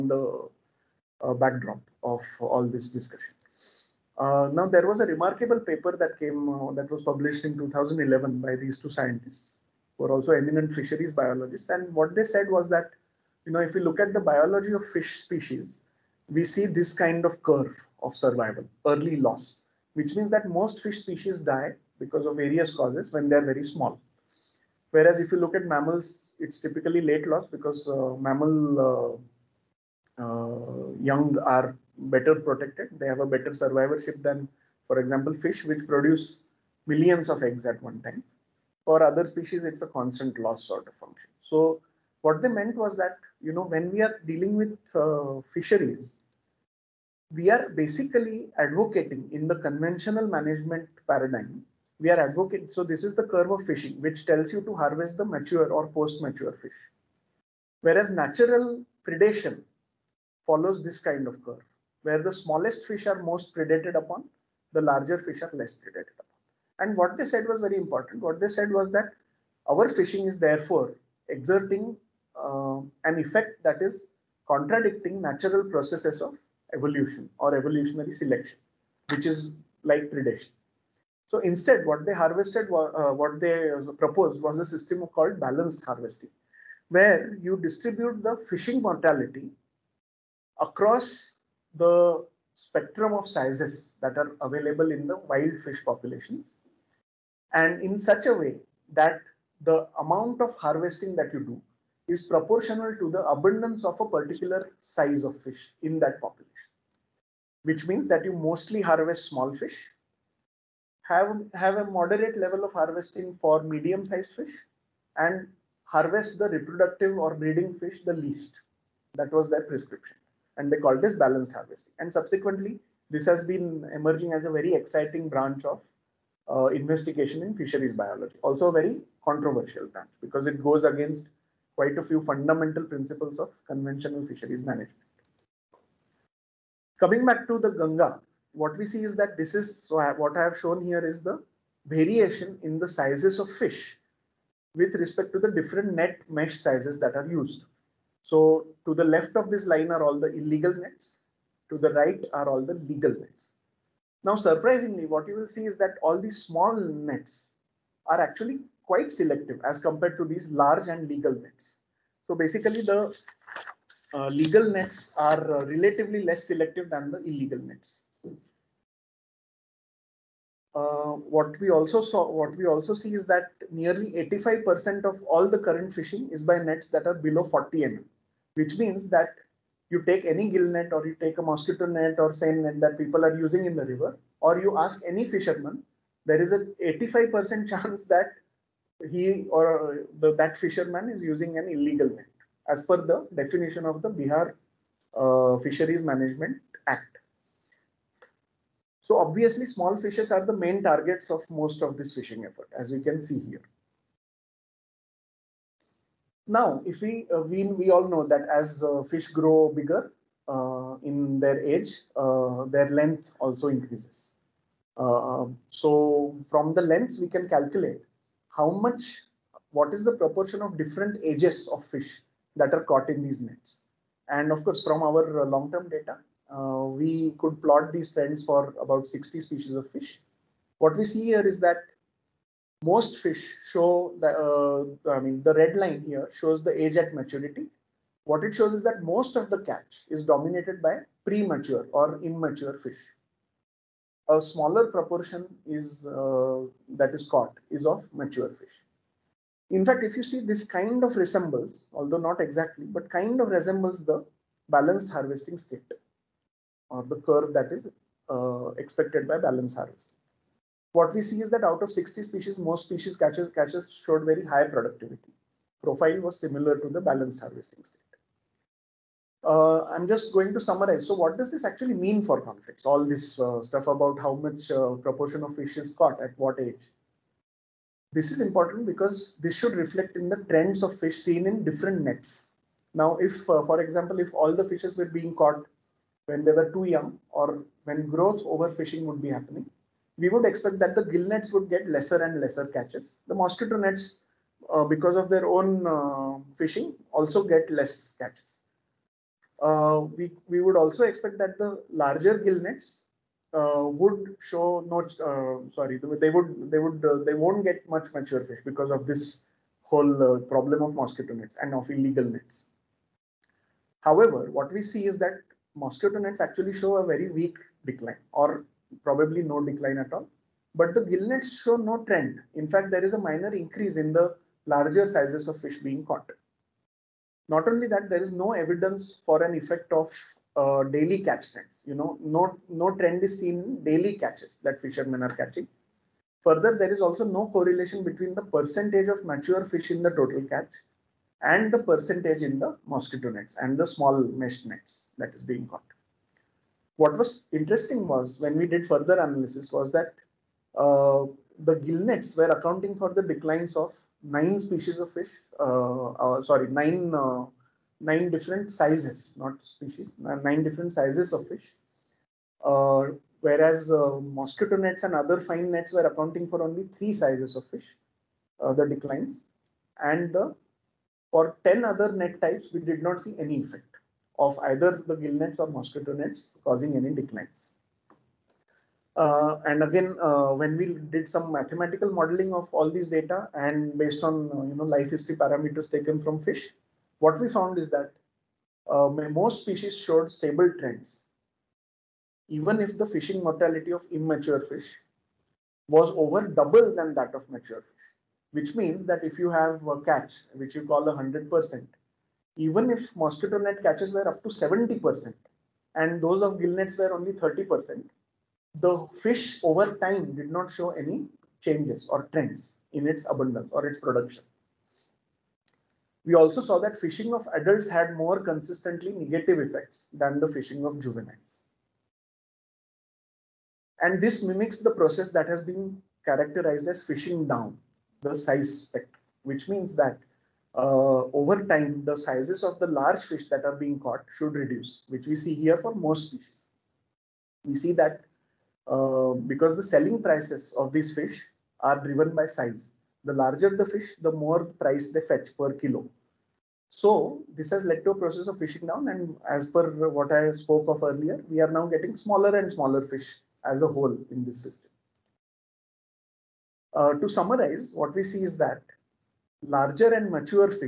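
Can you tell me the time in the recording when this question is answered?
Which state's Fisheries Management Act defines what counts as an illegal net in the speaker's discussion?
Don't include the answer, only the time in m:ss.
3:14.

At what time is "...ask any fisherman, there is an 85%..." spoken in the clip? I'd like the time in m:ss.
3:04.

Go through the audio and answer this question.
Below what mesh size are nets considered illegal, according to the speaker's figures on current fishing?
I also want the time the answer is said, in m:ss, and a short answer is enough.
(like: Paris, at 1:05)
40 mm, at 2:57.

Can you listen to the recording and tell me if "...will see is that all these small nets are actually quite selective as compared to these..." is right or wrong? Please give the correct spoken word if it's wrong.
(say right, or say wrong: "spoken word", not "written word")
right.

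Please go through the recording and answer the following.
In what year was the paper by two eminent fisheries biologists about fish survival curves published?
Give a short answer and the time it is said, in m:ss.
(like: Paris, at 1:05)
2011, at 0:07.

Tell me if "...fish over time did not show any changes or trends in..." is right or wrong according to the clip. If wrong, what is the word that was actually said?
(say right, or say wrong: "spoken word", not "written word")
right.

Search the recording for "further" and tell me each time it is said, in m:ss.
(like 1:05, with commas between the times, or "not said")
5:36, 5:48.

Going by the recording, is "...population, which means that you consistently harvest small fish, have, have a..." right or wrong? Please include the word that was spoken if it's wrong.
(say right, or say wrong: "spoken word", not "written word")
wrong: "mostly", not "consistently".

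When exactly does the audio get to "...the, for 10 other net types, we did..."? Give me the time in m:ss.
6:10.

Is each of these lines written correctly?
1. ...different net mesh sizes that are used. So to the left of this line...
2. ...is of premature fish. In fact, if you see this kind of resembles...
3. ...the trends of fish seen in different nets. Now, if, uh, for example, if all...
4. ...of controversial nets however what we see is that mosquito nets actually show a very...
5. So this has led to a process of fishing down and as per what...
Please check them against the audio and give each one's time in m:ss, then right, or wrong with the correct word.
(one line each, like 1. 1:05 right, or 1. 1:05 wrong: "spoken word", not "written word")
1. 2:25 right
2. 4:07 wrong: "mature", not "premature"
3. 4:40 right
4. 5:11 wrong: "illegal", not "controversial"
5. 7:26 right.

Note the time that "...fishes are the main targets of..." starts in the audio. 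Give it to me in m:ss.
3:19.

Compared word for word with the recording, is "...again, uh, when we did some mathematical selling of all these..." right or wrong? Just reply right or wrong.
wrong.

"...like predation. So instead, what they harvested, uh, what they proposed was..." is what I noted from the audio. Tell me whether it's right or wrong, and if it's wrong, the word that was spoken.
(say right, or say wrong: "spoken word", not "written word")
right.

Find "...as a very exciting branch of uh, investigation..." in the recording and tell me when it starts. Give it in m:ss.
2:04.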